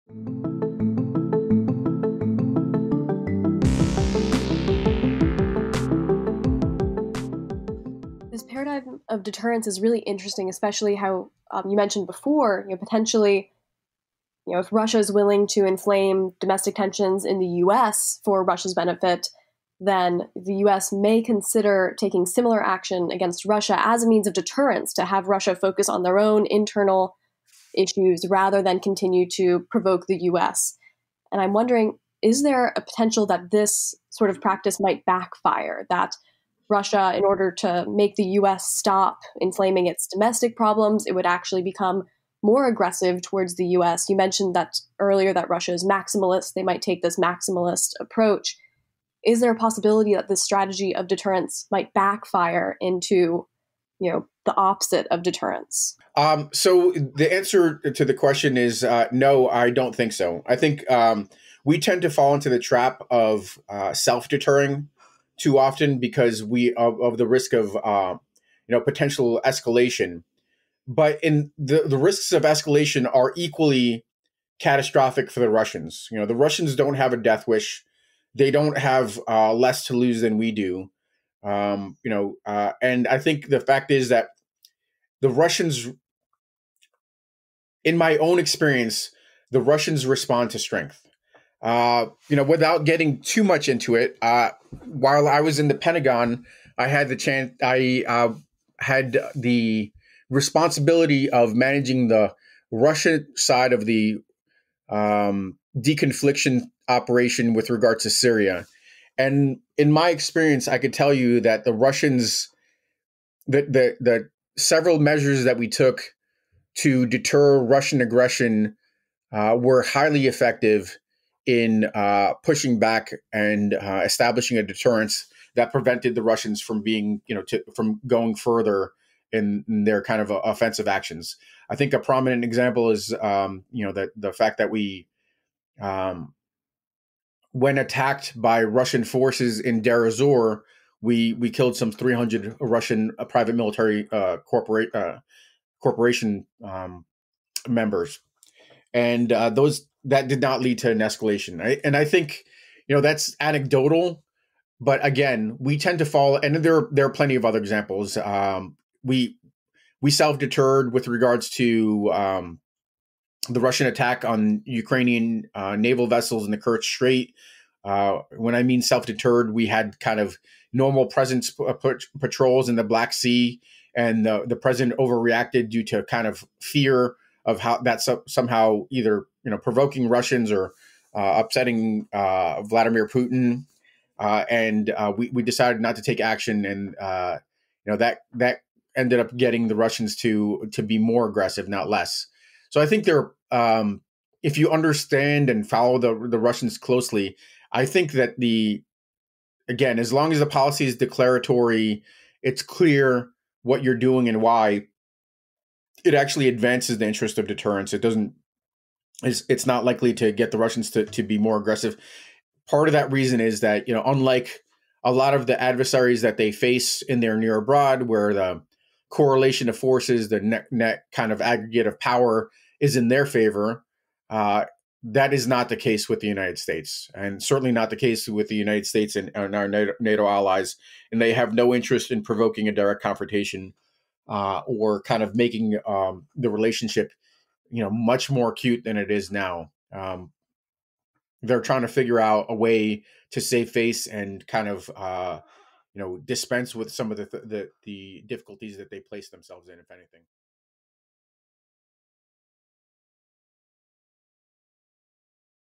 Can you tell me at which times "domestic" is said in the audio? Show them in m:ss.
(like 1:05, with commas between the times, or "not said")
0:16, 0:40.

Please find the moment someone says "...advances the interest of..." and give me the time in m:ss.
3:26.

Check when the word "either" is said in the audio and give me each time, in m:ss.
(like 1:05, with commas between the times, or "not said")
2:58.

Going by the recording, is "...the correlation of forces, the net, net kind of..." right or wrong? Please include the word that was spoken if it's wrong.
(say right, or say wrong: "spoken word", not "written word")
right.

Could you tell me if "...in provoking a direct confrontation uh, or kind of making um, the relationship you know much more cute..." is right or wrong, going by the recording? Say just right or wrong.
right.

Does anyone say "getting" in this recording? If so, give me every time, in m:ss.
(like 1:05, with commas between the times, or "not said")
1:32, 3:09.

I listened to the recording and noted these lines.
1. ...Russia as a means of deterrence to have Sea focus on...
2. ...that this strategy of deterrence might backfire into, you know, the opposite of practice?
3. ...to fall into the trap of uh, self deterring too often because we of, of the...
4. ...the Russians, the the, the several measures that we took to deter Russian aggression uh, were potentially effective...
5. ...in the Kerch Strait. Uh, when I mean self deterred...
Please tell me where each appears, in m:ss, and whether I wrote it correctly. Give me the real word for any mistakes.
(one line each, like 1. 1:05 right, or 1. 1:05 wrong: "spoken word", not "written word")
1. 0:23 wrong: "Russia", not "Sea"
2. 0:50 wrong: "deterrence", not "practice"
3. 1:02 right
4. 1:51 wrong: "highly", not "potentially"
5. 2:46 right.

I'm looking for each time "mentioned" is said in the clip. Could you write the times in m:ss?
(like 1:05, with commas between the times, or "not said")
0:11, 0:44.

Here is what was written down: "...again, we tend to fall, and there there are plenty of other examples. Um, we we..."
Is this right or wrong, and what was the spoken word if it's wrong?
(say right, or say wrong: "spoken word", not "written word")
right.